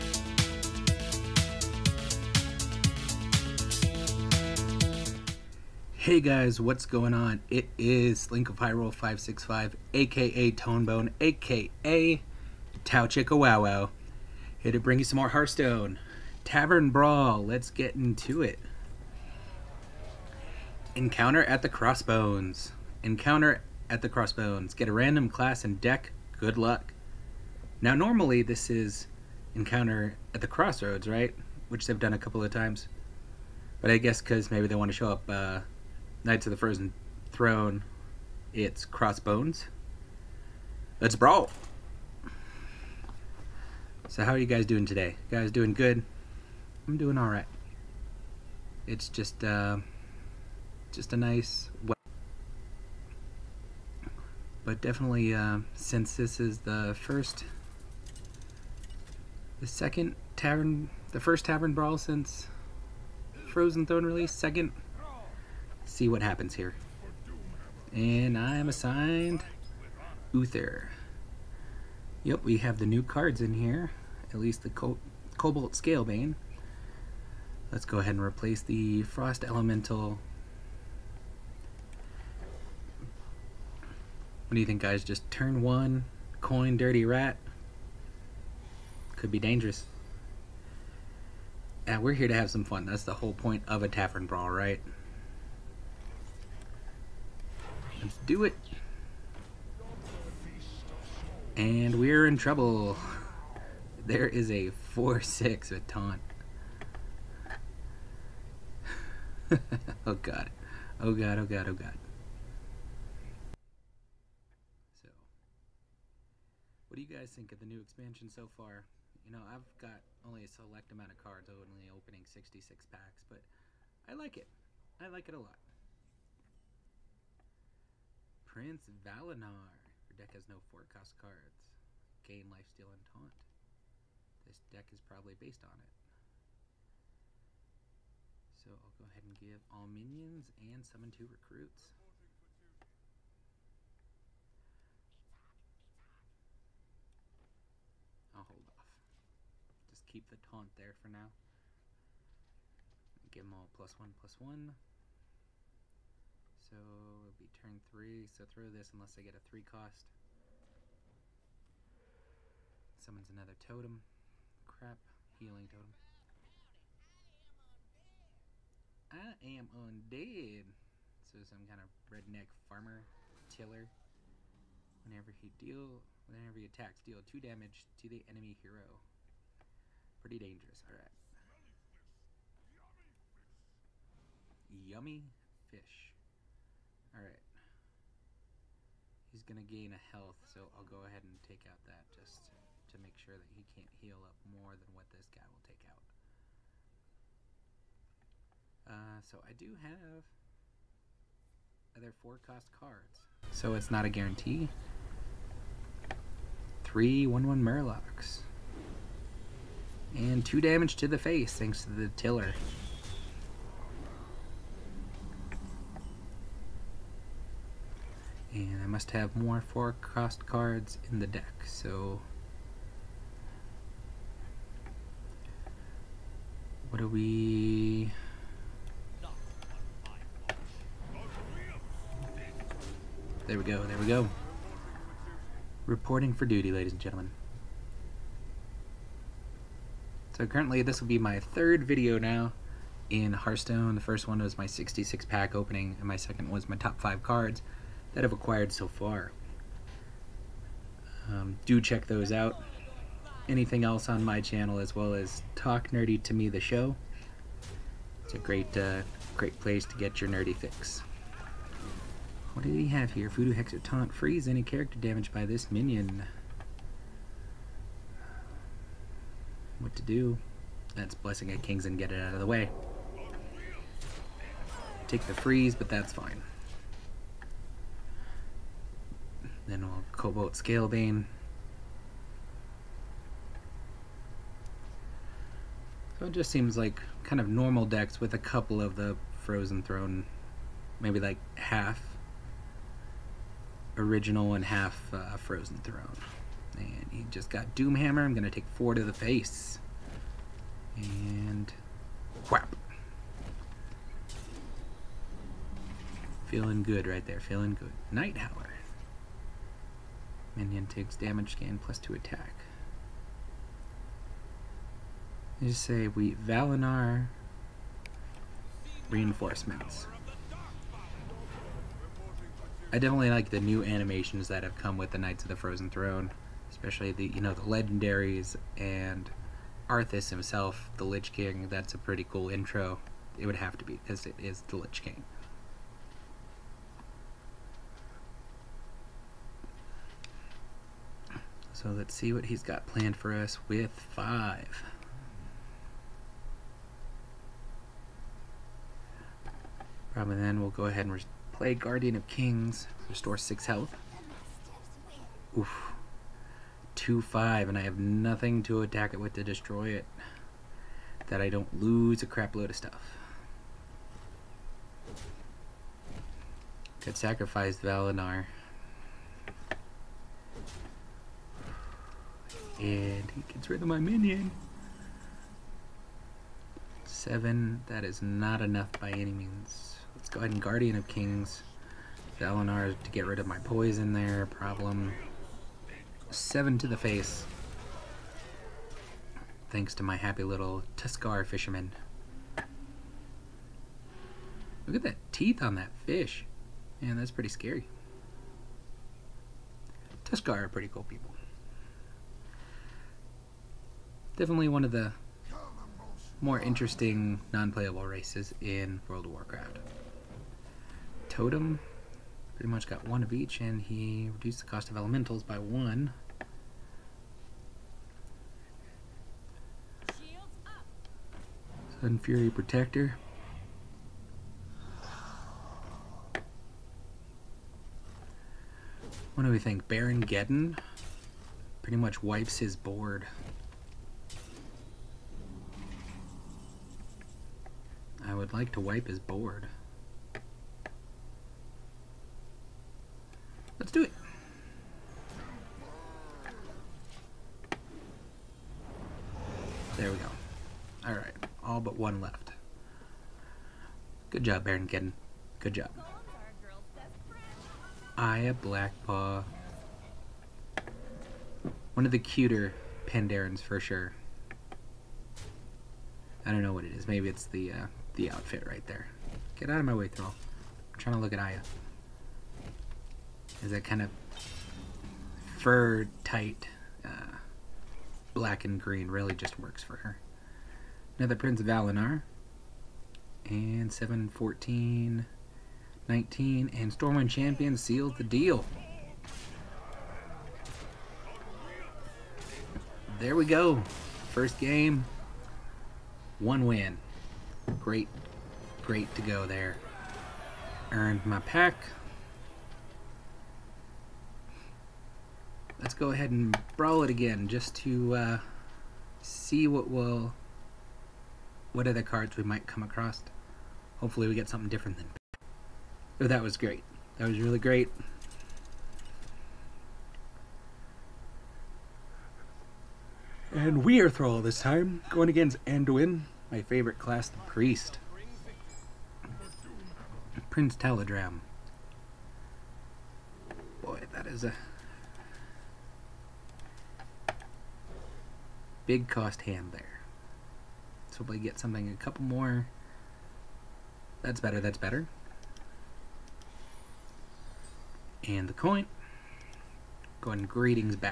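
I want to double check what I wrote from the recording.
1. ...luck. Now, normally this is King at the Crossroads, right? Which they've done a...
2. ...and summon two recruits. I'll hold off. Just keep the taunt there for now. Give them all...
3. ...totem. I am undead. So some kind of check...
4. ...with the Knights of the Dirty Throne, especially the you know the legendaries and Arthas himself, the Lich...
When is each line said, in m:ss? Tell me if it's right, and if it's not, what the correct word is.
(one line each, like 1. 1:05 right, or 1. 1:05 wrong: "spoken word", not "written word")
1. 0:26 wrong: "Encounter", not "King"
2. 2:20 right
3. 2:45 wrong: "redneck", not "check"
4. 5:24 wrong: "Frozen", not "Dirty".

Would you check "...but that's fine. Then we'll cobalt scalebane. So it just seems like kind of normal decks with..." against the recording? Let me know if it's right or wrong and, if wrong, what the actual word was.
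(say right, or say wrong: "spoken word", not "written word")
right.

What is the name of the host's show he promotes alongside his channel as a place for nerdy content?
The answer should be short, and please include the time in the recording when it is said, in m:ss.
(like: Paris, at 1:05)
Talk Nerdy to Me, at 4:15.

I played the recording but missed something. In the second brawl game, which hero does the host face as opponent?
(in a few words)
Anduin.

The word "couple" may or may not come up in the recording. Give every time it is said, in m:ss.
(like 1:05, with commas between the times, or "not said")
0:32, 4:48, 9:01.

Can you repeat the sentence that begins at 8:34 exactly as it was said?
Hopefully we get something different than.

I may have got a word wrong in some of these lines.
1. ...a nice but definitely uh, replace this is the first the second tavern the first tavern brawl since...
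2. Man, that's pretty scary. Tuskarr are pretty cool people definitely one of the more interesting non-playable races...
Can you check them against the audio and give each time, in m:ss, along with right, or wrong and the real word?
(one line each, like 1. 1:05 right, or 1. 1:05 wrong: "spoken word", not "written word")
1. 0:51 wrong: "since", not "replace"
2. 6:37 right.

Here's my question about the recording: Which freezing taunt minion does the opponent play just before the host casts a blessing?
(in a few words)
Voodoo Hexer.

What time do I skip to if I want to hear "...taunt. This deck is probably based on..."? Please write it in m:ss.
2:13.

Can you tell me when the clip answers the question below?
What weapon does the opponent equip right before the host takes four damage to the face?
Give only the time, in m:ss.
4:57.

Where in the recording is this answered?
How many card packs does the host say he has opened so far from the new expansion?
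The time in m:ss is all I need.
2:02.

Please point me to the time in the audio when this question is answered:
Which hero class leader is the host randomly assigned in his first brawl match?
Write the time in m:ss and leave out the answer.
1:10.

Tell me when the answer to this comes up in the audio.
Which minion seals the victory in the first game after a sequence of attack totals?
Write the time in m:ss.
8:06.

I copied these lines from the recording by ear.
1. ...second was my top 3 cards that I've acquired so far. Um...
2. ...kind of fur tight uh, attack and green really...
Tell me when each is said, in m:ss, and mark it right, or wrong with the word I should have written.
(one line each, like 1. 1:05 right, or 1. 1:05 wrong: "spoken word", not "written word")
1. 4:06 wrong: "5", not "3"
2. 7:53 wrong: "black", not "attack".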